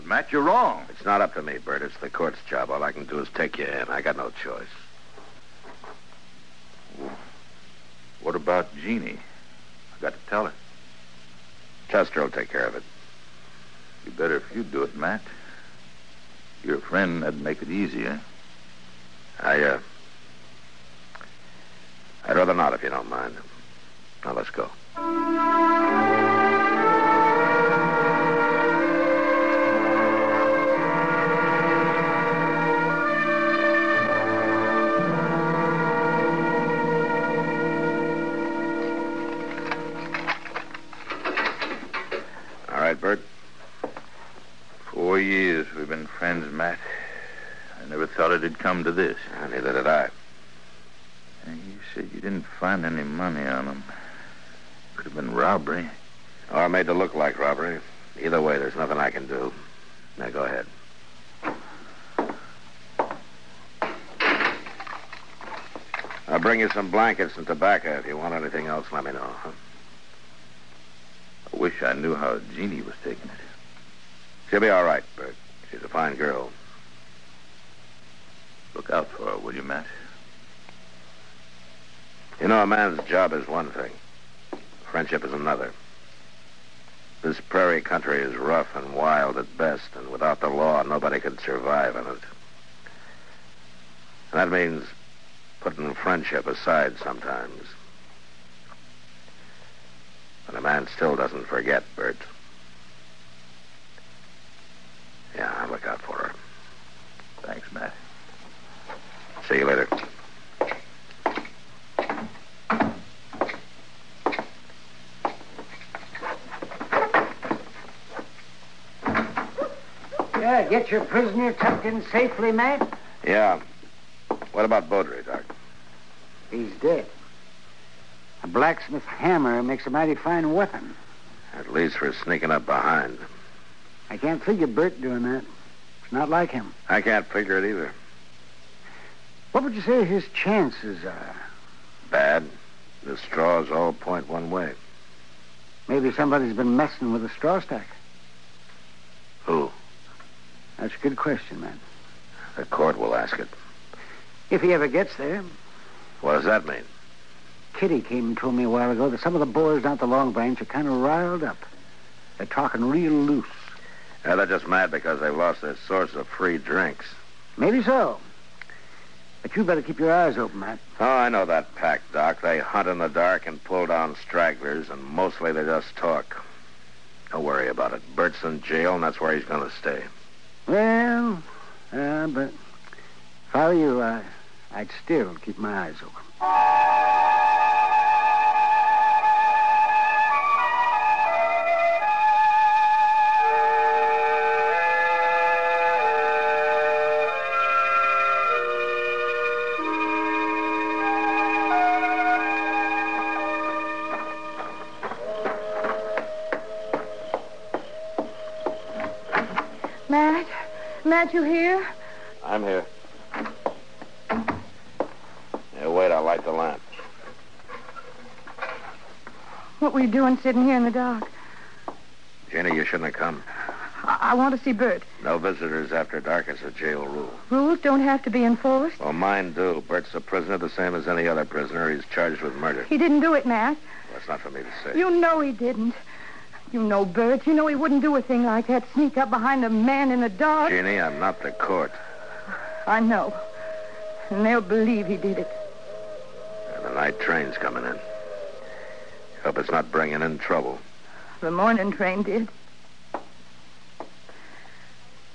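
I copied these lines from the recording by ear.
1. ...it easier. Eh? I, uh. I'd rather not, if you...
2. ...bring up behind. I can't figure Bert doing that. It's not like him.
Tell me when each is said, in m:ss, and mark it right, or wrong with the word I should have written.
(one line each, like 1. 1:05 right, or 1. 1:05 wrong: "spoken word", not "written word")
1. 0:17 right
2. 2:12 wrong: "sneaking", not "bring".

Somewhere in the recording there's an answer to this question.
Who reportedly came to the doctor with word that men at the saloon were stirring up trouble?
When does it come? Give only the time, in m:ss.
2:37.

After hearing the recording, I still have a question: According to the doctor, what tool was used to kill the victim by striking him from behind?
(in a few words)
A blacksmith's hammer.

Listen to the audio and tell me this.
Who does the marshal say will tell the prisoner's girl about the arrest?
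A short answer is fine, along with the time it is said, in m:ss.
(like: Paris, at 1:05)
Chester, at 0:11.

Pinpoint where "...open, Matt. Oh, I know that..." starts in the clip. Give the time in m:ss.
2:50.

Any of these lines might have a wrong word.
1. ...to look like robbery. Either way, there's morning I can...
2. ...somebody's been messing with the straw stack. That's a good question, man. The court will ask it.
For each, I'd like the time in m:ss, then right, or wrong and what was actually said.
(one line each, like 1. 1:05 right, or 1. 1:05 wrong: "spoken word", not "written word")
1. 0:56 wrong: "nothing", not "morning"
2. 2:26 right.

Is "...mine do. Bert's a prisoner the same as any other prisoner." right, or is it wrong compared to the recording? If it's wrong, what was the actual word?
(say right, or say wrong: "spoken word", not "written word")
right.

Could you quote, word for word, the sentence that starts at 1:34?
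And that means putting friendship aside sometimes.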